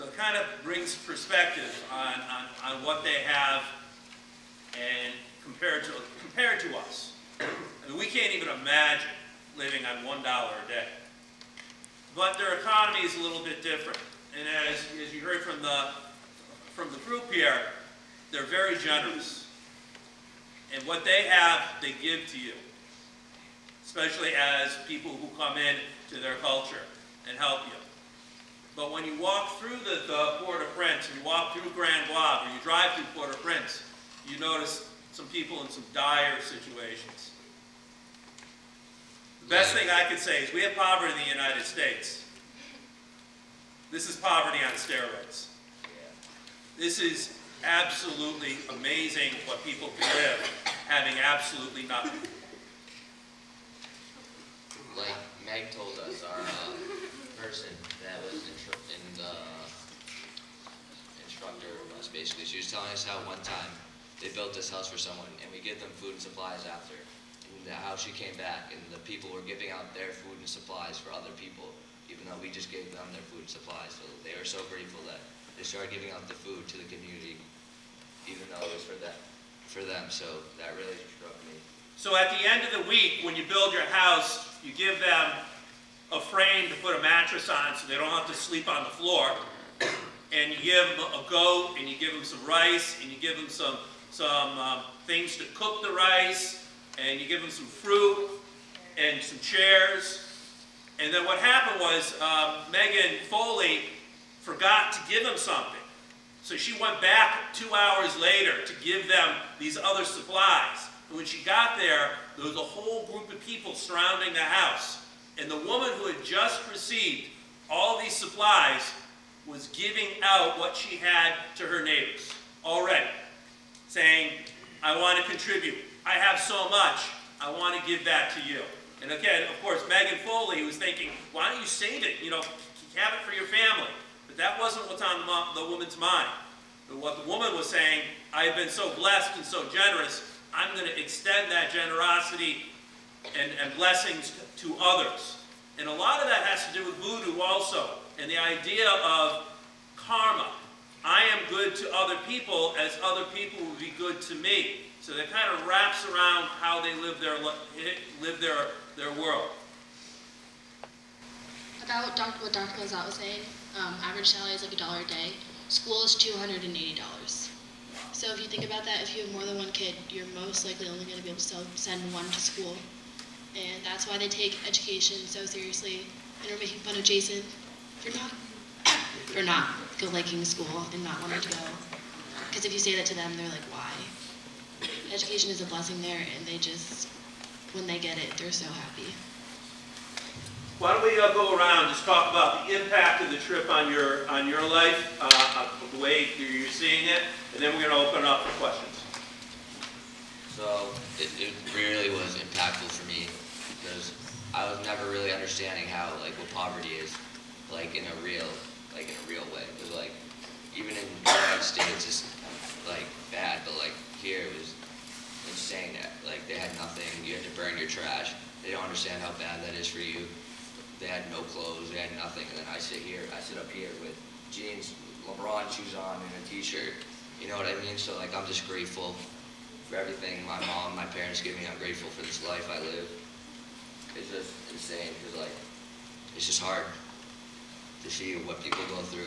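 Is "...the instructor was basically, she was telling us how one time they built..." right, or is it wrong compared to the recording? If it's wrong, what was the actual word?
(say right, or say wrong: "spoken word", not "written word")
right.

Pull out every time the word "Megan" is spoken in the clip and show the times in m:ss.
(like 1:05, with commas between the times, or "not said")
1:42, 2:09.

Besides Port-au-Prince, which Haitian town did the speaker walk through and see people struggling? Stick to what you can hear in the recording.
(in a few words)
Grand-Goâve.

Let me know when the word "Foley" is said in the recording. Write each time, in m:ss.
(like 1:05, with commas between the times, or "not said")
1:43, 2:10.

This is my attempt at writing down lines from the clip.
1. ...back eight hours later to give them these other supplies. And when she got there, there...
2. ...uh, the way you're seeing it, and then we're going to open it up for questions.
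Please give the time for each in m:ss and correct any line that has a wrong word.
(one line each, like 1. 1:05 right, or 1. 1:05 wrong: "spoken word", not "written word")
1. 1:46 wrong: "two", not "eight"
2. 3:15 right.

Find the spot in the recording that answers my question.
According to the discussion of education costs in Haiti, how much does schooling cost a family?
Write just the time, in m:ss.
2:46.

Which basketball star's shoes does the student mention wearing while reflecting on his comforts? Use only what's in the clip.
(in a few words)
LeBron.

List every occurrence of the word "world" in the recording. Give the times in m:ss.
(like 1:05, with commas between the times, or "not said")
2:39.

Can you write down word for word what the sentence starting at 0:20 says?
And what they have, they give to you, especially as people who come in to their culture and help you.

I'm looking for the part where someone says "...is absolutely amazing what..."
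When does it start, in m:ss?
0:47.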